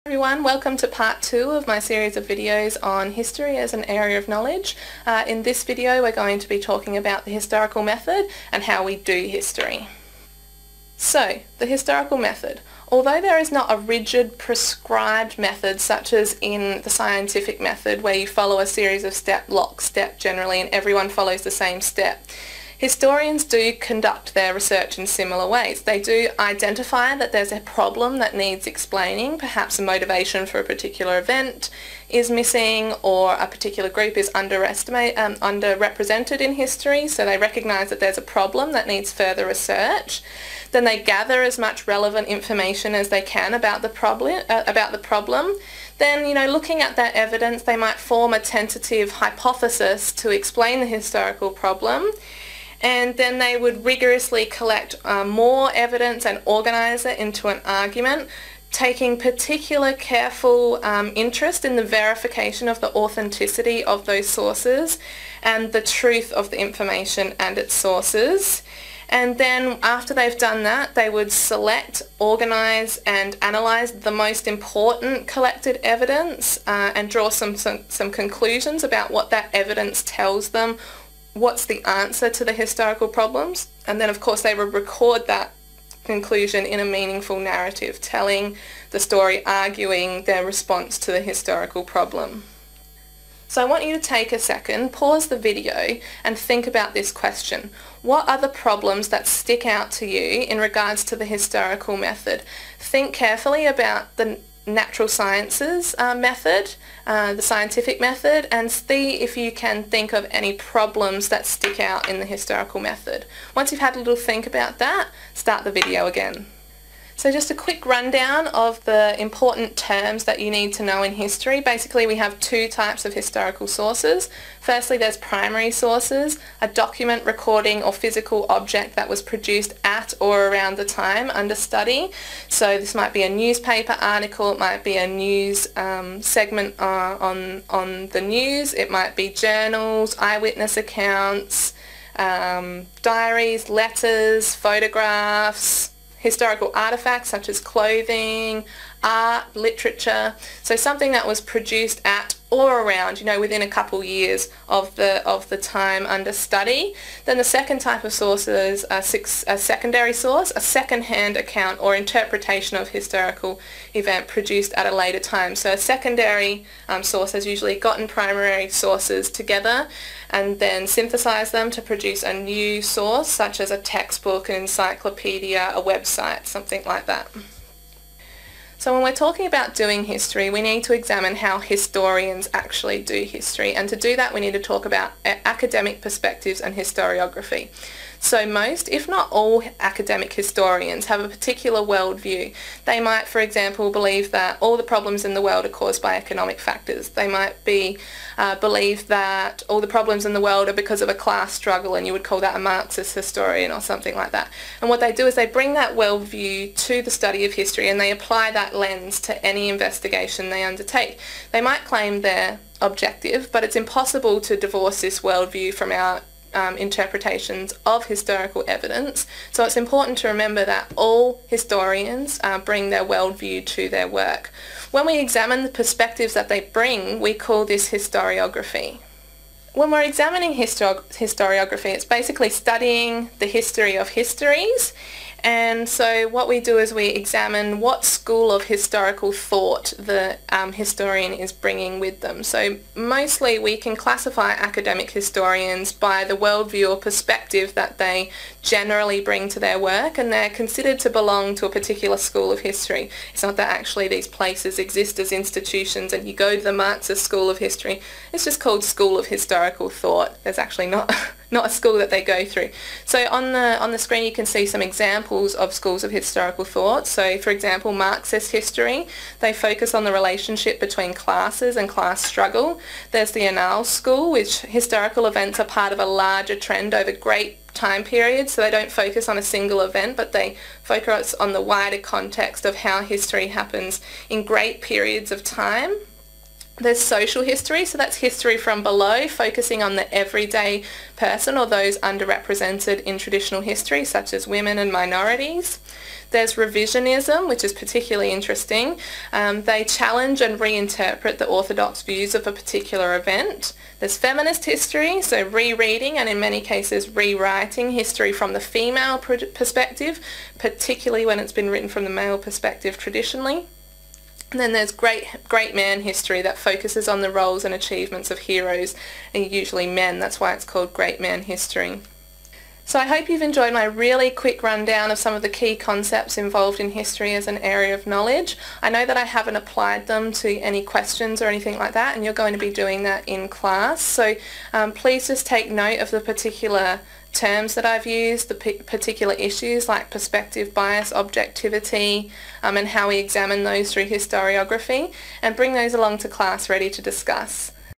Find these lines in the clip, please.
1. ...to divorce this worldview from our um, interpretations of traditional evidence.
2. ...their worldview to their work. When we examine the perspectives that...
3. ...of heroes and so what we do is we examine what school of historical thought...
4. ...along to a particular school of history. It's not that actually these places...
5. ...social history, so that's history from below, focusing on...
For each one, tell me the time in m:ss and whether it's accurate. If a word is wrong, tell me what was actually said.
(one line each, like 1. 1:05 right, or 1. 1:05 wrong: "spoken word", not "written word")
1. 3:34 wrong: "historical", not "traditional"
2. 3:42 right
3. 3:53 wrong: "histories", not "heroes"
4. 4:11 wrong: "belong", not "along"
5. 4:46 right.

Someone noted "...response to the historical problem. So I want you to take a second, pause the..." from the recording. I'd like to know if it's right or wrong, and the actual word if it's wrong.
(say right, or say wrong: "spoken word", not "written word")
right.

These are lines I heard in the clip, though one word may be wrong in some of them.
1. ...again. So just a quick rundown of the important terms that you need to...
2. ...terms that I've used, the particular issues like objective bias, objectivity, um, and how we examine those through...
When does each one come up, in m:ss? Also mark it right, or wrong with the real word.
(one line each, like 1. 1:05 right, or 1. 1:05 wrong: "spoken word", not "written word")
1. 1:56 right
2. 5:37 wrong: "perspective", not "objective".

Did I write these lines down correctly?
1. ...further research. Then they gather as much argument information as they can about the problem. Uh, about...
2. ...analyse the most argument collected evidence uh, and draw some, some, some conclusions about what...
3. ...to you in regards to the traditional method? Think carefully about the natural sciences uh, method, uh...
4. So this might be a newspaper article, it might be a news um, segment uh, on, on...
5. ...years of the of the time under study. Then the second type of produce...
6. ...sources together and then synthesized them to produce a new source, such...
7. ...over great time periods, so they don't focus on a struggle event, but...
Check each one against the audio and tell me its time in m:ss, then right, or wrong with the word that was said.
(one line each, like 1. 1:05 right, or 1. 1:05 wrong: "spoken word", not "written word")
1. 0:39 wrong: "relevant", not "argument"
2. 1:13 wrong: "important", not "argument"
3. 1:39 wrong: "historical", not "traditional"
4. 2:12 right
5. 2:34 wrong: "source", not "produce"
6. 2:48 right
7. 4:36 wrong: "single", not "struggle".